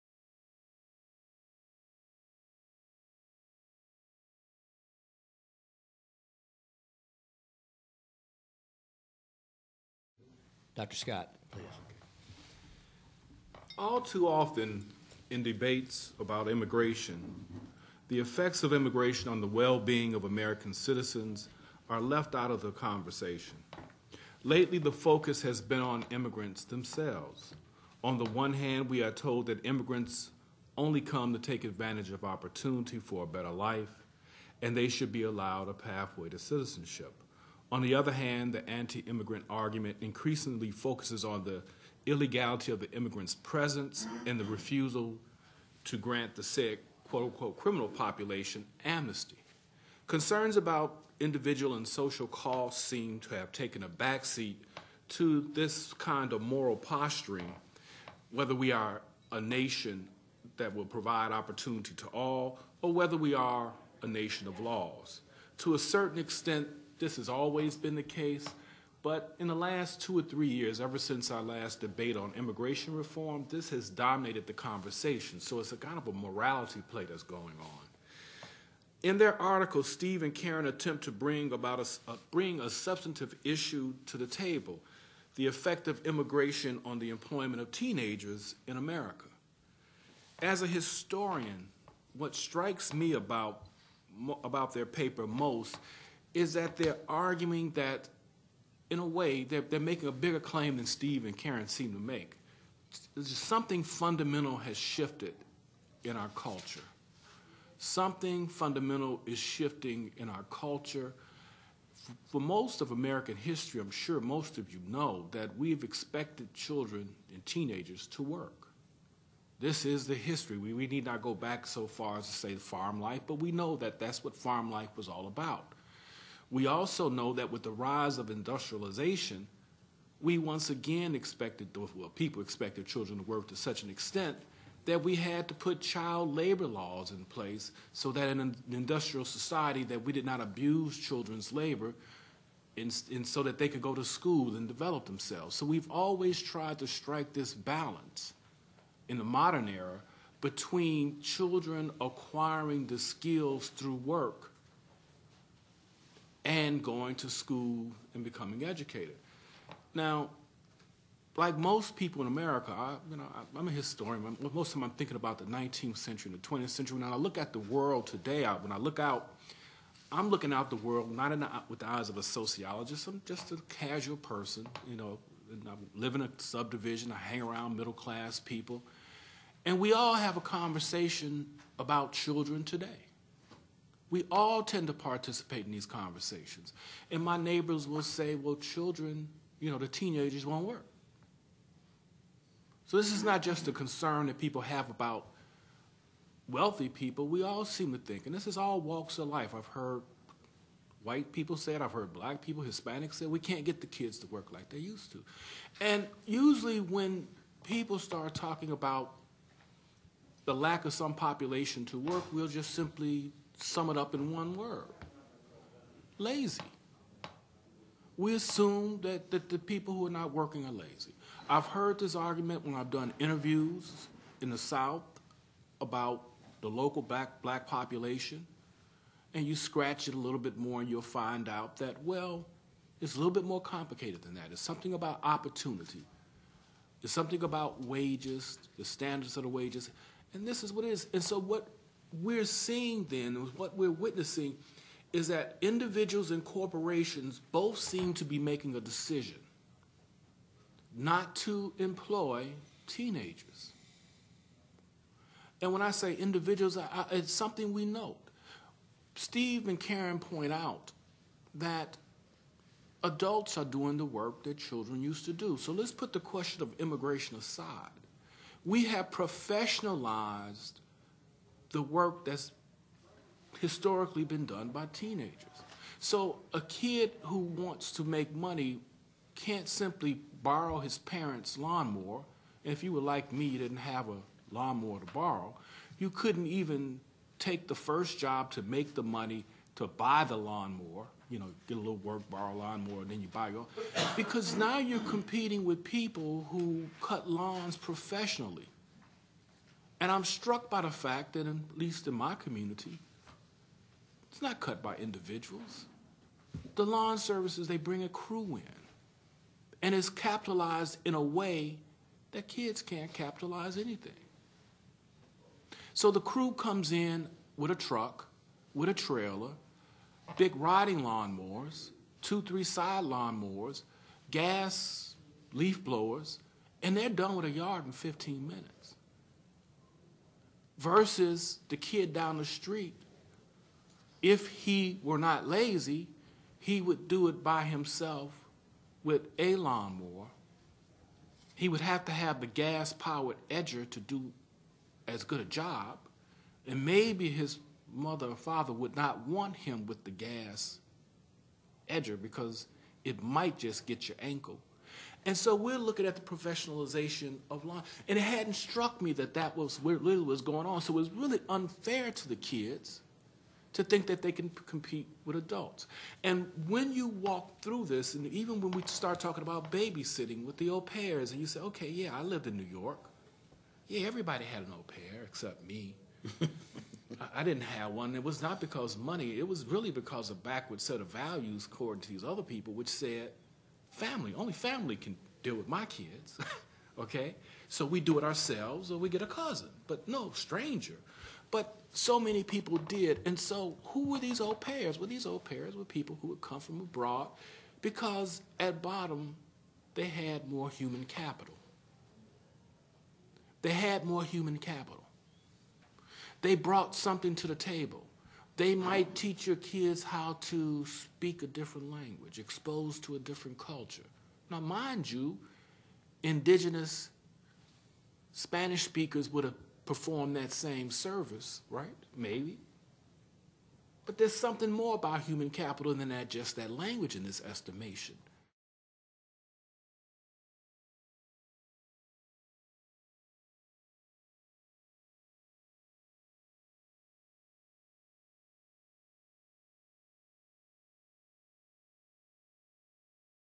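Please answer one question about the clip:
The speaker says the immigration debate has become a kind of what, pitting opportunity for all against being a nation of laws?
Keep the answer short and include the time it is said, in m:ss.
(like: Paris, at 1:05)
morality play, at 1:16.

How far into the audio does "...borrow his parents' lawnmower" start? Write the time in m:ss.
4:40.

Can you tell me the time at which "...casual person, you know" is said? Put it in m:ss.
2:53.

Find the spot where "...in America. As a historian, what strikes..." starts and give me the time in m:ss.
1:28.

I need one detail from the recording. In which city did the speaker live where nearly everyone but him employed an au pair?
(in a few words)
New York.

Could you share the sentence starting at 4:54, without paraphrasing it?
Because now you're competing with people who cut lawns professionally.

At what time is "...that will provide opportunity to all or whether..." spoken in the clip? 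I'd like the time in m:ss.
1:00.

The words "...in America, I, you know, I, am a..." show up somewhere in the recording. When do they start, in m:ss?
2:42.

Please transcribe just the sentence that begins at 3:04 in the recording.
We all tend to participate in these conversations.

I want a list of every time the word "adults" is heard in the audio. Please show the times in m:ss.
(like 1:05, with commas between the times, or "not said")
4:23, 6:05.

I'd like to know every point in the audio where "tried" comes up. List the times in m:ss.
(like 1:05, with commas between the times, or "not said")
2:26.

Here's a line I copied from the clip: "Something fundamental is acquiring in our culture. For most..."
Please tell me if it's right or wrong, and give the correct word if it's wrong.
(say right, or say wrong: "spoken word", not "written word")
wrong: "shifting", not "acquiring".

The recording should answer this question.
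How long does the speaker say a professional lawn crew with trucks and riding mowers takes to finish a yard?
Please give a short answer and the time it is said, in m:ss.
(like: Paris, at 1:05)
15 minutes, at 5:27.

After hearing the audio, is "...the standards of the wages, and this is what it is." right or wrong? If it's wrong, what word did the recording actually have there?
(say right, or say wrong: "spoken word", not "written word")
right.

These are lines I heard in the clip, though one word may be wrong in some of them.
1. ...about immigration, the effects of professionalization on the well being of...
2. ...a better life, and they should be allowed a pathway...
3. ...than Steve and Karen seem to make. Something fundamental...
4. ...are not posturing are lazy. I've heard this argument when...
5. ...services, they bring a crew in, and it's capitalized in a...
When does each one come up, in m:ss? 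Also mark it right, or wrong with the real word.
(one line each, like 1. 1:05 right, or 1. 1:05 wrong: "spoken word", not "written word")
1. 0:16 wrong: "immigration", not "professionalization"
2. 0:33 right
3. 1:40 right
4. 3:40 wrong: "working", not "posturing"
5. 5:07 right.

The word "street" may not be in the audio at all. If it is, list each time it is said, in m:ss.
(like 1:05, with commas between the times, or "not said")
5:32.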